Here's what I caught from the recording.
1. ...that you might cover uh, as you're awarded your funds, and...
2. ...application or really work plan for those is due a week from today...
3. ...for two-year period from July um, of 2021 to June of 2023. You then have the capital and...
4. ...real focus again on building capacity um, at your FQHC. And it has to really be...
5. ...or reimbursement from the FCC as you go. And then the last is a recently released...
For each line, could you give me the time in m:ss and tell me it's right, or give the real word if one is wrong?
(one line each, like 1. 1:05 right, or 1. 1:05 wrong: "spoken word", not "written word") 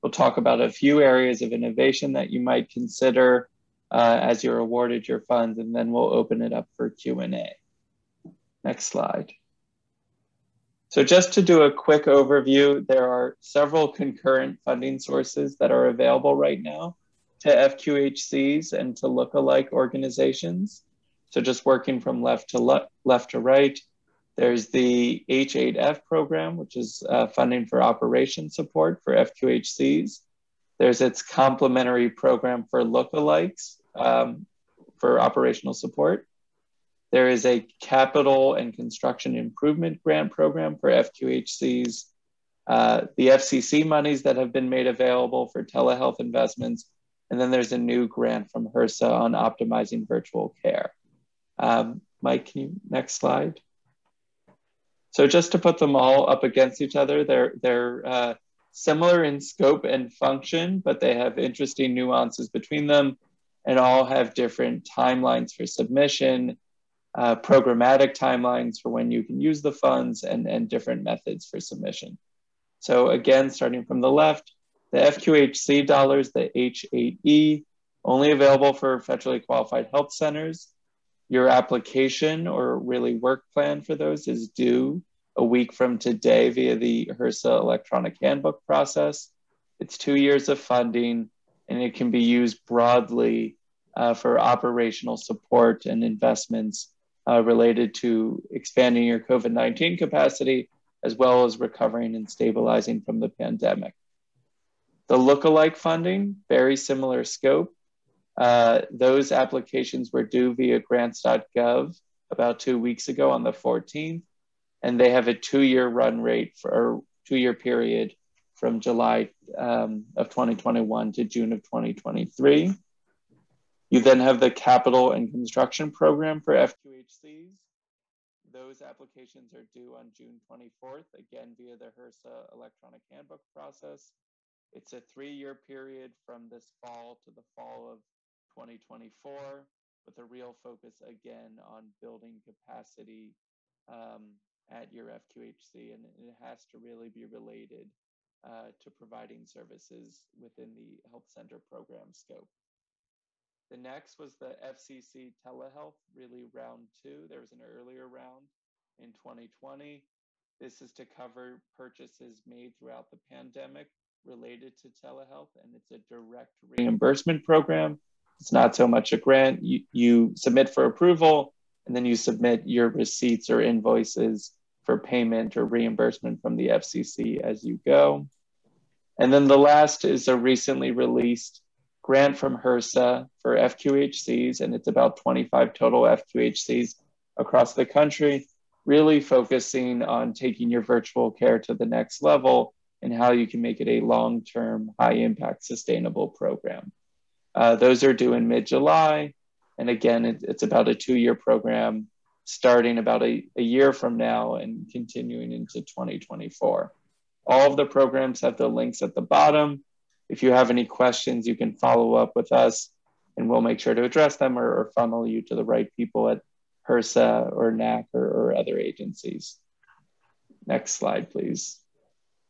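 1. 0:02 wrong: "consider", not "cover"
2. 1:21 right
3. 1:56 right
4. 2:20 right
5. 2:55 right.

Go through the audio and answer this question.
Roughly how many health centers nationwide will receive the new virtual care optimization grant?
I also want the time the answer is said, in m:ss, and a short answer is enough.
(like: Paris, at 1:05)
25, at 3:05.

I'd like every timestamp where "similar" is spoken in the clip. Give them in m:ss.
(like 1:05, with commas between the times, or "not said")
0:58, 1:46.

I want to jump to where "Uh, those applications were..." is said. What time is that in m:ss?
1:48.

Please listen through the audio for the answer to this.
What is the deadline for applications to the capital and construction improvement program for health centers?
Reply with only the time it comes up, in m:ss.
2:10.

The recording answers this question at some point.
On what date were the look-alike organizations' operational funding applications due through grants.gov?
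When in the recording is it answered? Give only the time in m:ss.
1:53.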